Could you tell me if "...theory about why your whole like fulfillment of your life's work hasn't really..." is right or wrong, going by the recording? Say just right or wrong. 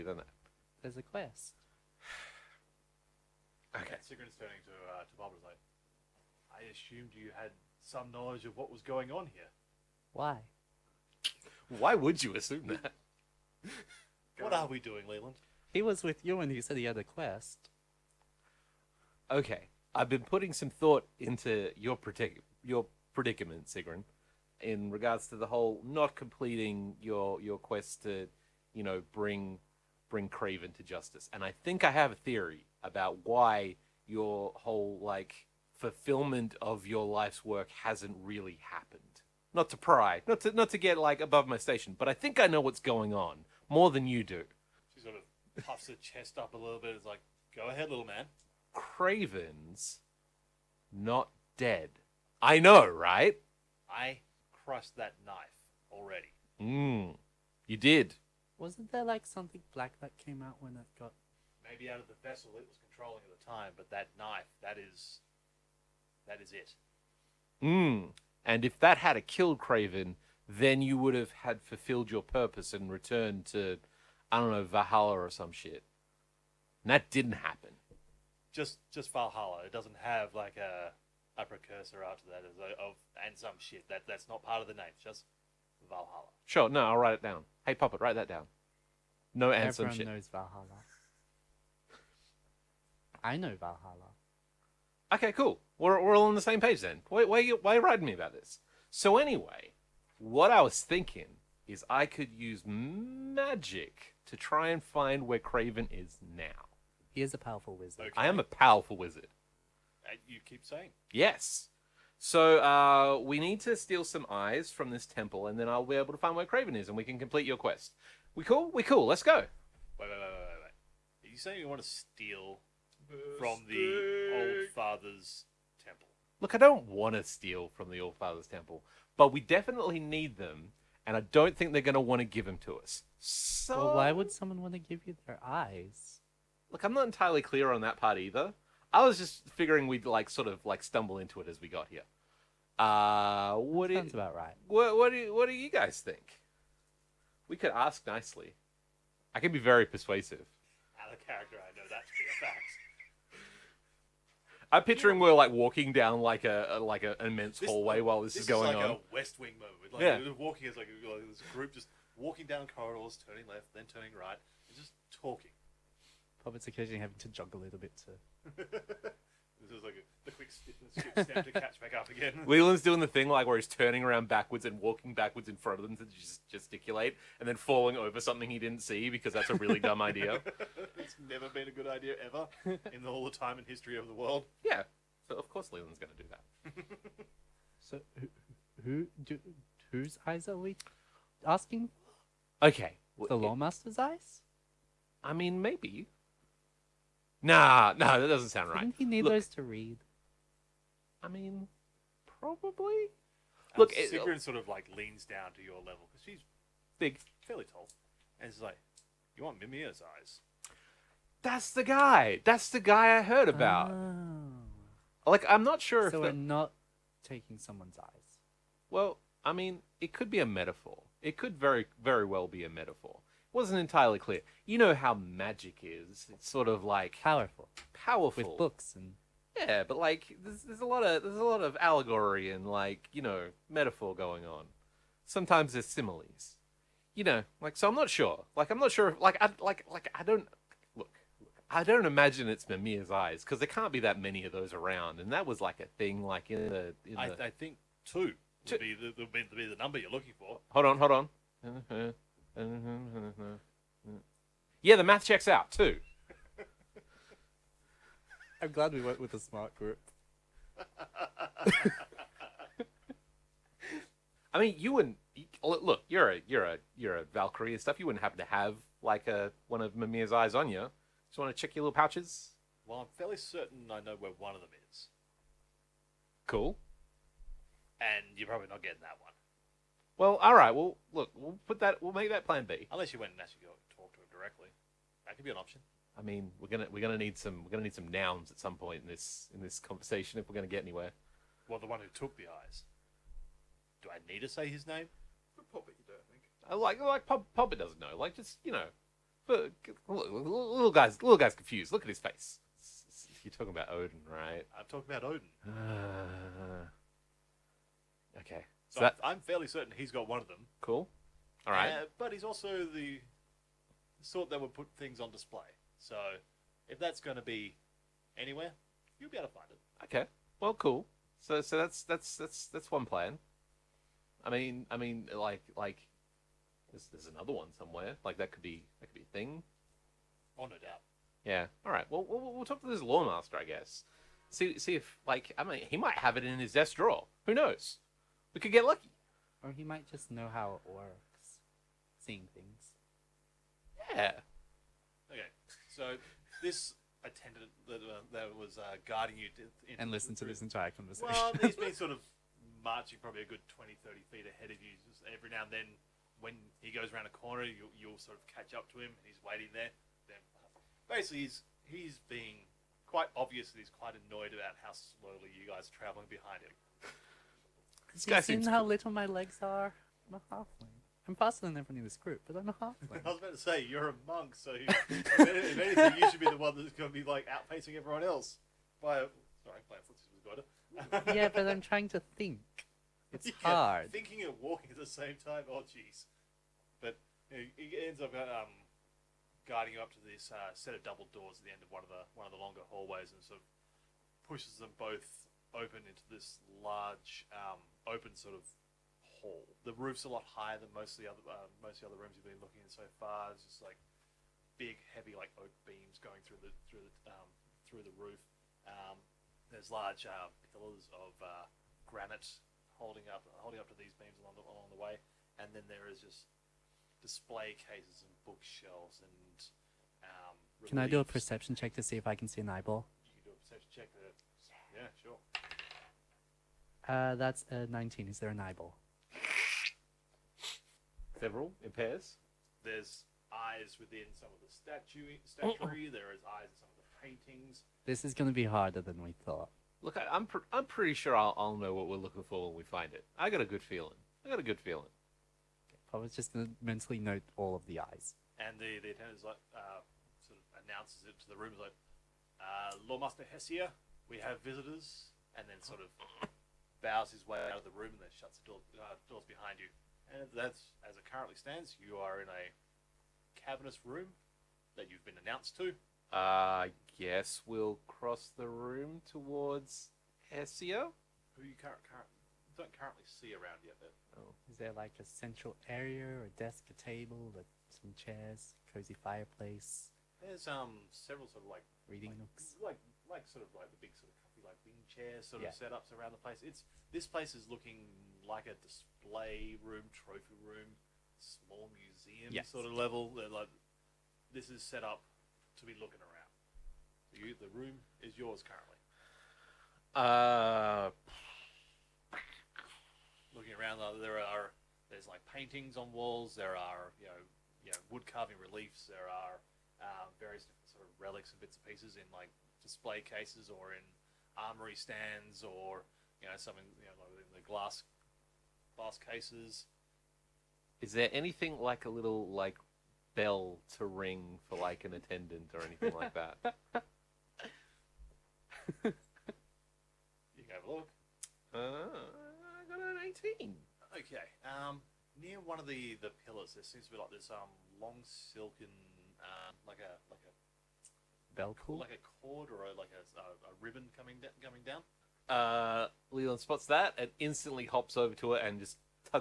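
right.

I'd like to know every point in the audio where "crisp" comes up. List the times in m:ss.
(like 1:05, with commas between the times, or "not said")
not said.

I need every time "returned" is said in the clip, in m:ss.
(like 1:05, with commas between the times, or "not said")
1:12.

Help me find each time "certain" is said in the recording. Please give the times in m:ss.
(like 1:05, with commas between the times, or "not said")
4:33, 5:09.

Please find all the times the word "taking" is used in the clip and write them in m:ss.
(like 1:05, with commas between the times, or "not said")
3:37.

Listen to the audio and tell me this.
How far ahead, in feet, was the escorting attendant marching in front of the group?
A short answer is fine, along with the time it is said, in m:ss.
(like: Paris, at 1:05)
20 to 30 feet, at 5:53.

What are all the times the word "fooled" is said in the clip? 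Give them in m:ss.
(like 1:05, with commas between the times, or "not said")
not said.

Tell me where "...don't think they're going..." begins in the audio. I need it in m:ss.
2:11.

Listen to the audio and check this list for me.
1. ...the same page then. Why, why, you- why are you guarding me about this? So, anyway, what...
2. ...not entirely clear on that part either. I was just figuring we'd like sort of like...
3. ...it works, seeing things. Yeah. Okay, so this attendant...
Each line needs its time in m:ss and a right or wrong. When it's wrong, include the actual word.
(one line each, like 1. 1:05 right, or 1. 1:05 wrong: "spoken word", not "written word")
1. 1:36 wrong: "writing", not "guarding"
2. 2:16 right
3. 5:40 right.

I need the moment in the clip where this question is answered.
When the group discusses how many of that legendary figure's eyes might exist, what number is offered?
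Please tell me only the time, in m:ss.
4:08.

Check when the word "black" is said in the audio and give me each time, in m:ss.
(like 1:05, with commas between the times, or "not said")
0:59.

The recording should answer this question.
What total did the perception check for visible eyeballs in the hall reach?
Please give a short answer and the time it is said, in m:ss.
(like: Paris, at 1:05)
19, at 7:07.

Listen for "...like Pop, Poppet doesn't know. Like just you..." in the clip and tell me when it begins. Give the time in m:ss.
4:56.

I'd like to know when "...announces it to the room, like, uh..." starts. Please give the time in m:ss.
7:30.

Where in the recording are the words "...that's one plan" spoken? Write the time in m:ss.
5:22.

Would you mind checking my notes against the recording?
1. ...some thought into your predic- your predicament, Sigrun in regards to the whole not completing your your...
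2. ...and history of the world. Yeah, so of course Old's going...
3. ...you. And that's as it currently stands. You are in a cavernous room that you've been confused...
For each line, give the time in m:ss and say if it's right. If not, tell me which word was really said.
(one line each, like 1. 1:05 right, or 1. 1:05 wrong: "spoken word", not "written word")
1. 0:20 right
2. 3:03 wrong: "Leland", not "Old"
3. 7:39 wrong: "announced", not "confused".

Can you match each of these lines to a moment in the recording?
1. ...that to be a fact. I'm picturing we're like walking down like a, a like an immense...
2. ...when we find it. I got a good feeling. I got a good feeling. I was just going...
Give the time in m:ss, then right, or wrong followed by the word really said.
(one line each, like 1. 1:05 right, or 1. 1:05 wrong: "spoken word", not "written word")
1. 2:31 right
2. 7:22 right.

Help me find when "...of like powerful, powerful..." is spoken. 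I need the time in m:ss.
3:46.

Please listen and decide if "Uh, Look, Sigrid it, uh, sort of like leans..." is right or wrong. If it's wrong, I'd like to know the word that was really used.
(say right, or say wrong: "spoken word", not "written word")
right.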